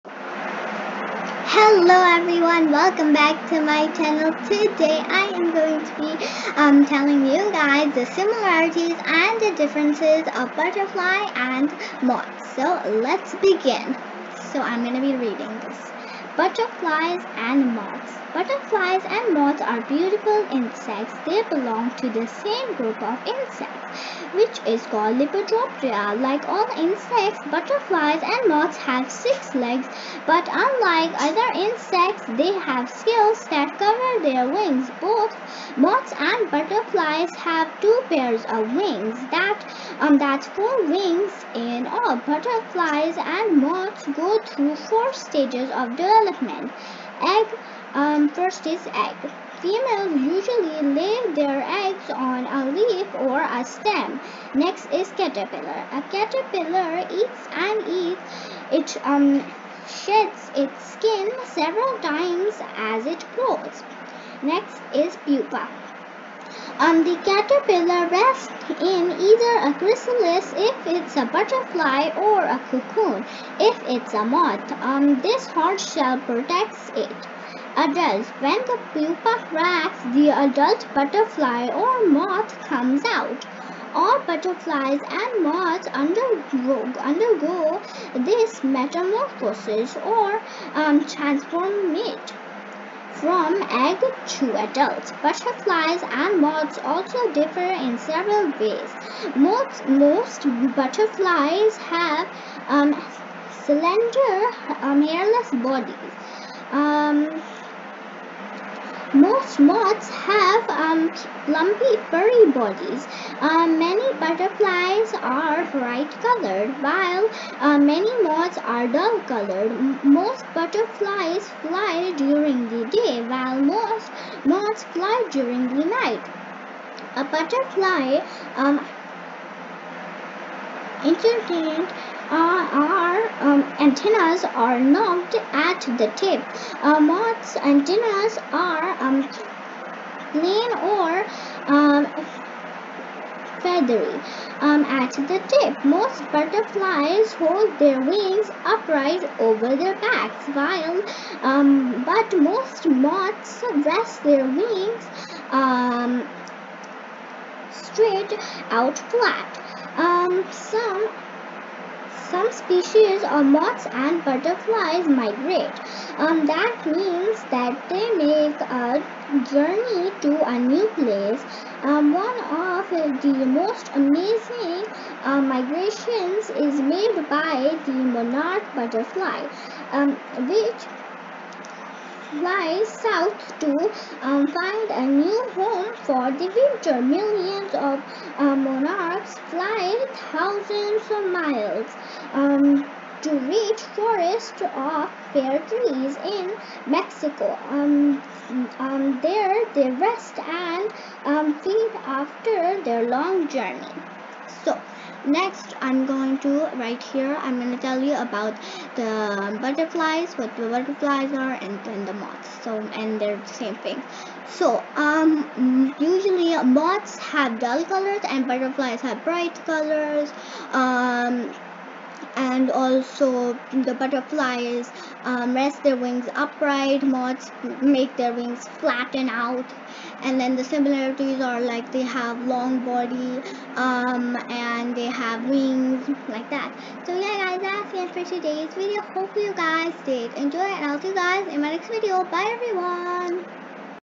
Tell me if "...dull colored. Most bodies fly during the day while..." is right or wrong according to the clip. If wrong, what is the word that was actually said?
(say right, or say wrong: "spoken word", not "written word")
wrong: "butterflies", not "bodies".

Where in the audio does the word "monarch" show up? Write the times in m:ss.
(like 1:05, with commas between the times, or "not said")
2:57, 3:08.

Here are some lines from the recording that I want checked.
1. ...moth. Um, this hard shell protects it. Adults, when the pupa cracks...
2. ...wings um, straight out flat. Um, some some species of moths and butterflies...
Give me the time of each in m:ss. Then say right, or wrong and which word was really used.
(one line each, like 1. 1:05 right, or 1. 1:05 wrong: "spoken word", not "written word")
1. 1:14 right
2. 2:34 right.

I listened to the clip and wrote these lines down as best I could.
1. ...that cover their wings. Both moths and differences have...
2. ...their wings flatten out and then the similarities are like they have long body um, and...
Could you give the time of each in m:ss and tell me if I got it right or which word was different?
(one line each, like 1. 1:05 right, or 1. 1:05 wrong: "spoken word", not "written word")
1. 0:33 wrong: "butterflies", not "differences"
2. 3:48 right.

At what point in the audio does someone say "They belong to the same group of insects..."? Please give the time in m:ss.
0:21.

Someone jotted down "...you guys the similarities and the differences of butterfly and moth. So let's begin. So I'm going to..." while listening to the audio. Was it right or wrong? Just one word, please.
right.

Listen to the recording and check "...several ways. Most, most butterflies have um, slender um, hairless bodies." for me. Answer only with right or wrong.
right.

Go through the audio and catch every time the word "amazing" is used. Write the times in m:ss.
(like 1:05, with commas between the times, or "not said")
2:53.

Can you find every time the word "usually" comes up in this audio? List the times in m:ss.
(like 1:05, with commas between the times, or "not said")
0:50, 3:35.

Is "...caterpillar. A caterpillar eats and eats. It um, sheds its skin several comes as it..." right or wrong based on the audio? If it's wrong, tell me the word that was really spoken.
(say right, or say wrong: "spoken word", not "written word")
wrong: "times", not "comes".